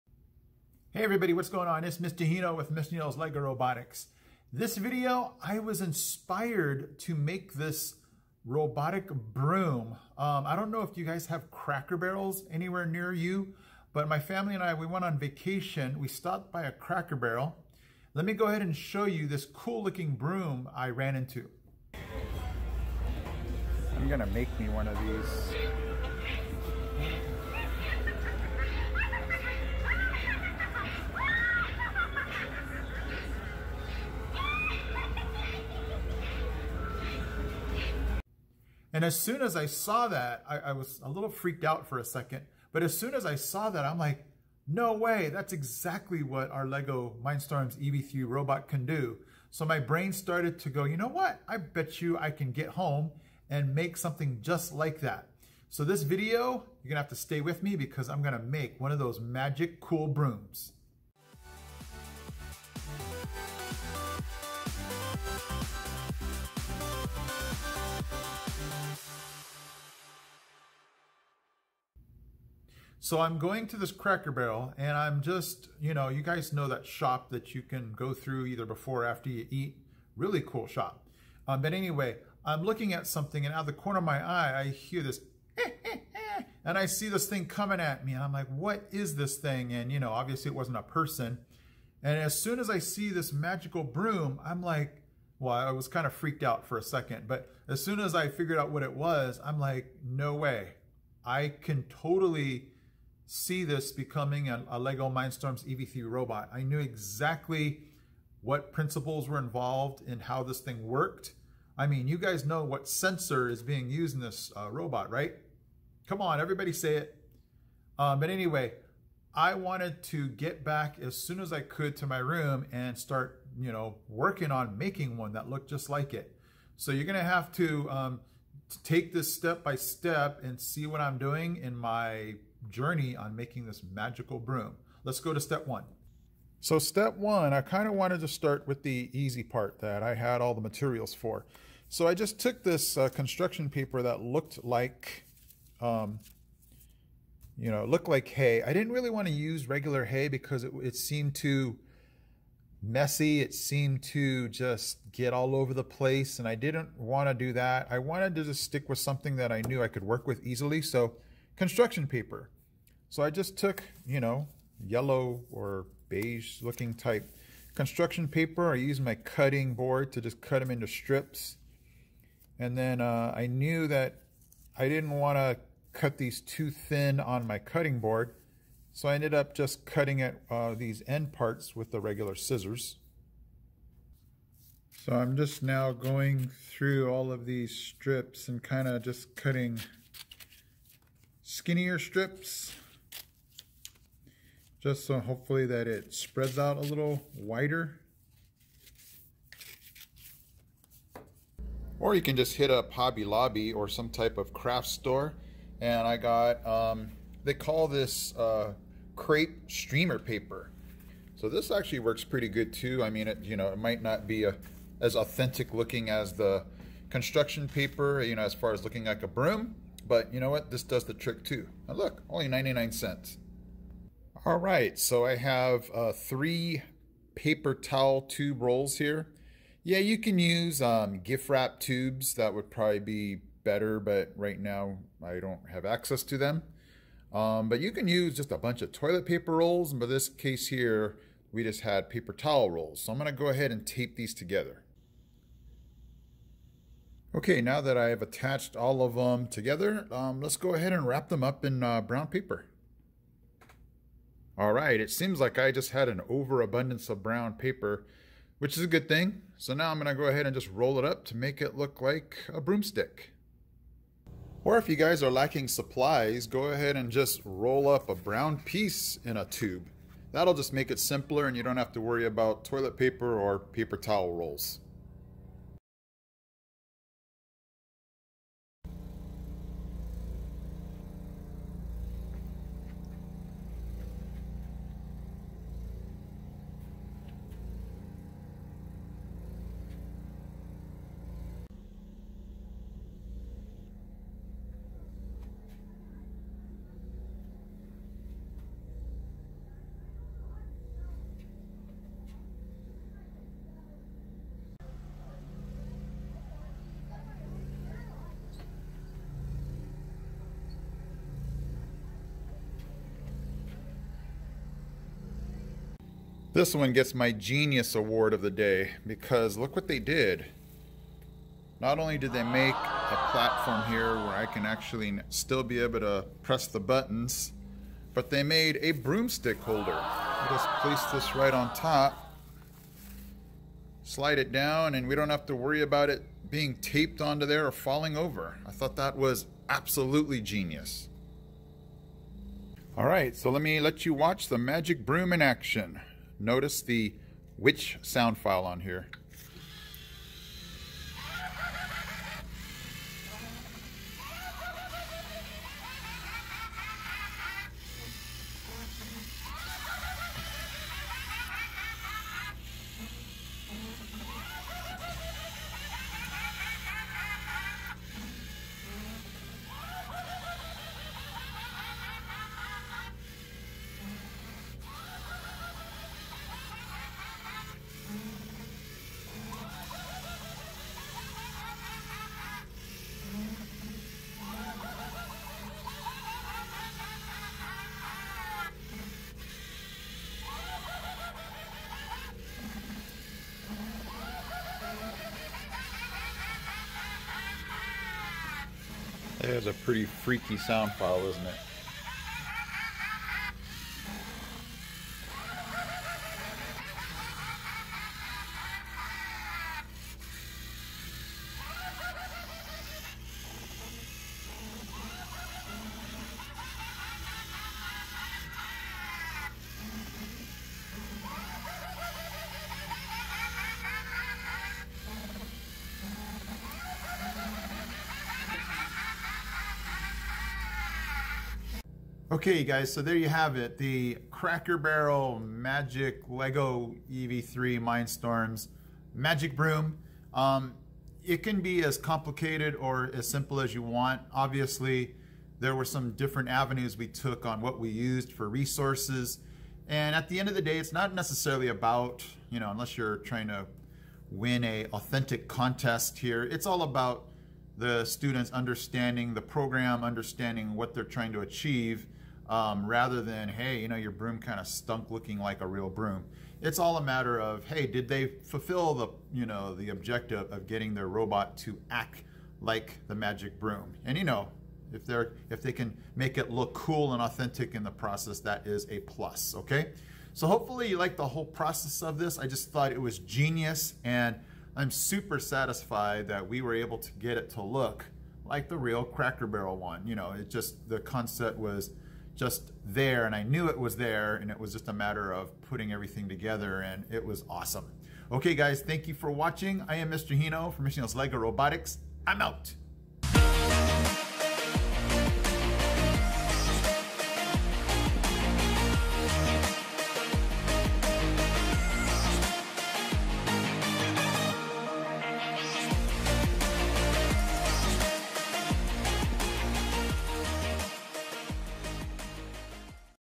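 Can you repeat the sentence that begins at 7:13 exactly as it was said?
The Cracker Barrel Magic Lego EV3 Mindstorms Magic Broom.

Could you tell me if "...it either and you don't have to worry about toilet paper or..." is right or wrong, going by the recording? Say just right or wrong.
wrong.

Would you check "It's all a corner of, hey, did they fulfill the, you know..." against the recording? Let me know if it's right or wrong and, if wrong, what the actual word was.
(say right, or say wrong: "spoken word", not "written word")
wrong: "matter", not "corner".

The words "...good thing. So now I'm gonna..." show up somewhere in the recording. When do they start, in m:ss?
4:18.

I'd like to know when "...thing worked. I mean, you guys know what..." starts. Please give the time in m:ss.
1:50.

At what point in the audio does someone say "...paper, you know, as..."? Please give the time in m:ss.
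3:37.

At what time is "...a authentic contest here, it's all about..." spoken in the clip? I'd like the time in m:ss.
7:34.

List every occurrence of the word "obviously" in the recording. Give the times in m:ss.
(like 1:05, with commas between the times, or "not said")
1:30, 7:24.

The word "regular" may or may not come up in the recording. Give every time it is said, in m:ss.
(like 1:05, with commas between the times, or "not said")
2:29, 3:01.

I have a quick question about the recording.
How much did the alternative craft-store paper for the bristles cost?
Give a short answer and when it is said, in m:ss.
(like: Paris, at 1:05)
99 cents, at 3:42.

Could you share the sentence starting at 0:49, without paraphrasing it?
So my brain started to go, you know what?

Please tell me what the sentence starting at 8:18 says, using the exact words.
Okay guys, thank you for watching.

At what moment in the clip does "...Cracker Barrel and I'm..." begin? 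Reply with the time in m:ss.
1:13.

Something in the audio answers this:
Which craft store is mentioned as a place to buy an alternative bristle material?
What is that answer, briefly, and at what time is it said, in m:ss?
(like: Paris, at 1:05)
Hobby Lobby, at 3:22.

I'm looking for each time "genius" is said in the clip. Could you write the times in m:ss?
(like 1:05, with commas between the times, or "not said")
5:17, 5:40, 8:03.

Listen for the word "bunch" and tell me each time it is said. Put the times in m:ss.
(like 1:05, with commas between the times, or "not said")
3:58.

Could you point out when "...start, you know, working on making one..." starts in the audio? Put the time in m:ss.
2:02.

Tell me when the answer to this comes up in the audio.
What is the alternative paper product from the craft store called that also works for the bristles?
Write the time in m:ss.
3:29.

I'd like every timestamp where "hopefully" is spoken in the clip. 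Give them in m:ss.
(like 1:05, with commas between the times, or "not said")
3:15, 8:00.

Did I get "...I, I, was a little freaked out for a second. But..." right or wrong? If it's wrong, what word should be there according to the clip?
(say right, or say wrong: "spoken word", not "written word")
right.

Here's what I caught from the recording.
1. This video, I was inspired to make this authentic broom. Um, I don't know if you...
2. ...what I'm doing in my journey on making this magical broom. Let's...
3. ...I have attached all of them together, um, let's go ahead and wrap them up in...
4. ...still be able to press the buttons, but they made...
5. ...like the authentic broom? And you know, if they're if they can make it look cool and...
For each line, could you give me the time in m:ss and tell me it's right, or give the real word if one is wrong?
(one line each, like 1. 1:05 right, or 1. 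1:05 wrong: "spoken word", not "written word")
1. 0:04 wrong: "robotic", not "authentic"
2. 2:10 right
3. 4:07 right
4. 5:25 right
5. 7:52 wrong: "magic", not "authentic".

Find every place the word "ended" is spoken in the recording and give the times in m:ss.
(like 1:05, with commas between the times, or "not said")
2:59.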